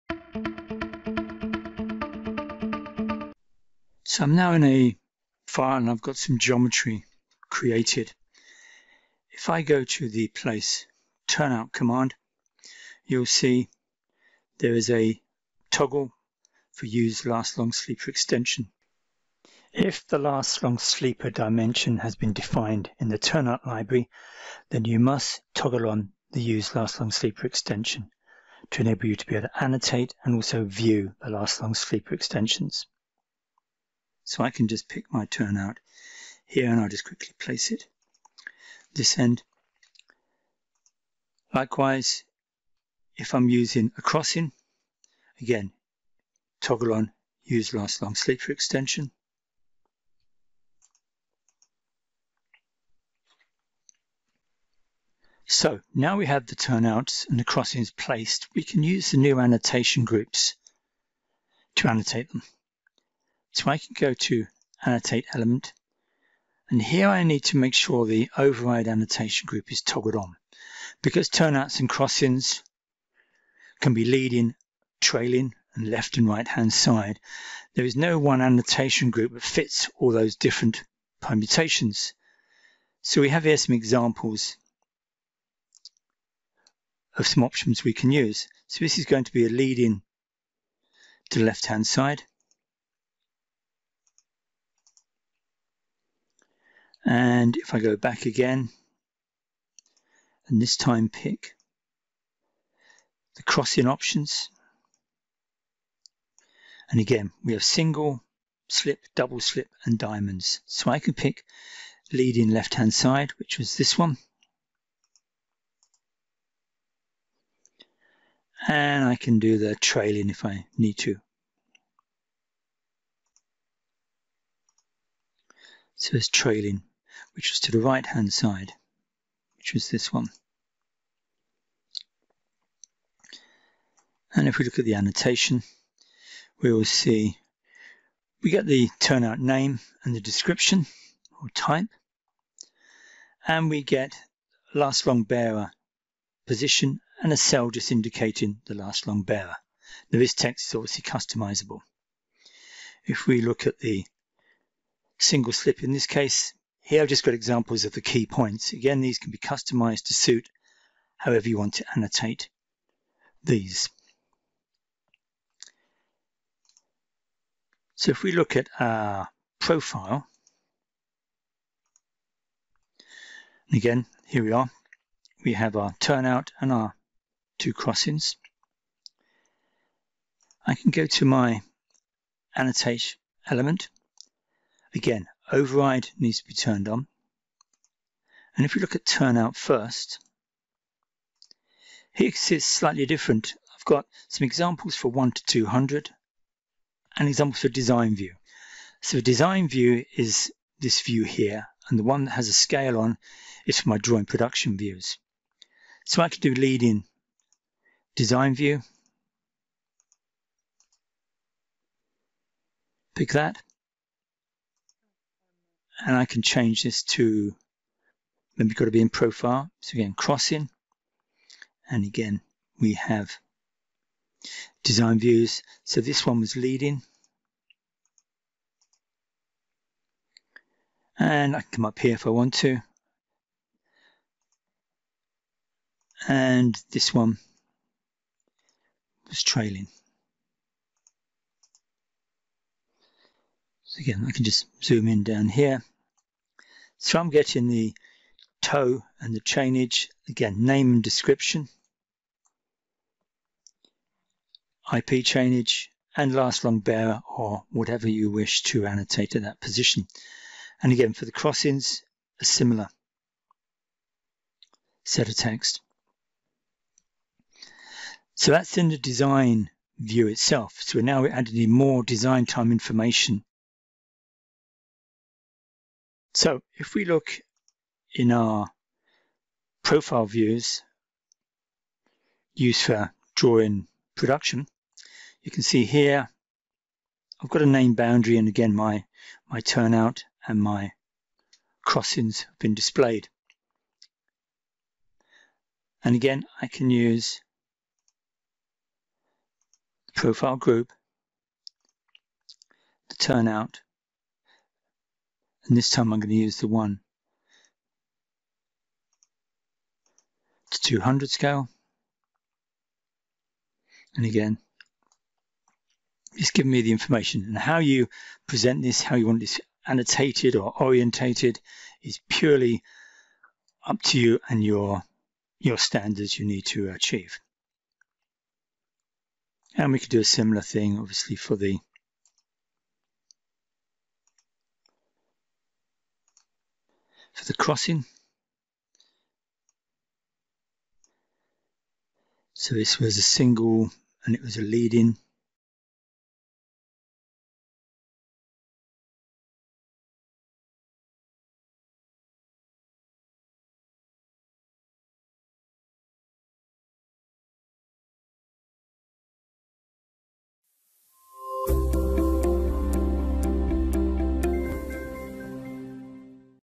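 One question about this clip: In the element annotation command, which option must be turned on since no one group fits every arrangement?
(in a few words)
Override annotation group.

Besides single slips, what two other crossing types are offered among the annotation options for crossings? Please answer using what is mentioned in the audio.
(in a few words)
Double slip and diamonds.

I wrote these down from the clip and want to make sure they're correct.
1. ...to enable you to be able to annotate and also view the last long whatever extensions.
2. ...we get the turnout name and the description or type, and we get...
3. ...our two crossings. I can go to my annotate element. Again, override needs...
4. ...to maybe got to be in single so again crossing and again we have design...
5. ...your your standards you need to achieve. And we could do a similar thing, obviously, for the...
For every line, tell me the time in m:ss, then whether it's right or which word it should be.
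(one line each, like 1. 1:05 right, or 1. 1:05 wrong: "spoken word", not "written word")
1. 0:28 wrong: "sleeper", not "whatever"
2. 2:18 right
3. 2:56 right
4. 3:37 wrong: "profile", not "single"
5. 5:24 right.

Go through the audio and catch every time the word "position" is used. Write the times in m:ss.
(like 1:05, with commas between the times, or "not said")
2:26, 4:19.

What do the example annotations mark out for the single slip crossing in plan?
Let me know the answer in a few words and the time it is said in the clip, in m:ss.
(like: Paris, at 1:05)
Key points, at 2:38.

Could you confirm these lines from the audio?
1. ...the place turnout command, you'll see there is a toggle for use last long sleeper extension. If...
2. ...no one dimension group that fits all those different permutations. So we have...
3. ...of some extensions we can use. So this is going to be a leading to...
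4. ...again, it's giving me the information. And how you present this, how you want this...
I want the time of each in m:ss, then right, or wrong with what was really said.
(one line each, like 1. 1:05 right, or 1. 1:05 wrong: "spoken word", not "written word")
1. 0:10 right
2. 1:17 wrong: "annotation", not "dimension"
3. 1:27 wrong: "options", not "extensions"
4. 5:14 right.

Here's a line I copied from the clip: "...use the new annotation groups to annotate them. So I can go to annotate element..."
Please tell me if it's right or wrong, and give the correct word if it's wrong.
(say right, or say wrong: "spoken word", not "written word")
right.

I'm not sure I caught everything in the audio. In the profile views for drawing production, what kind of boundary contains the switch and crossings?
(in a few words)
Name boundary.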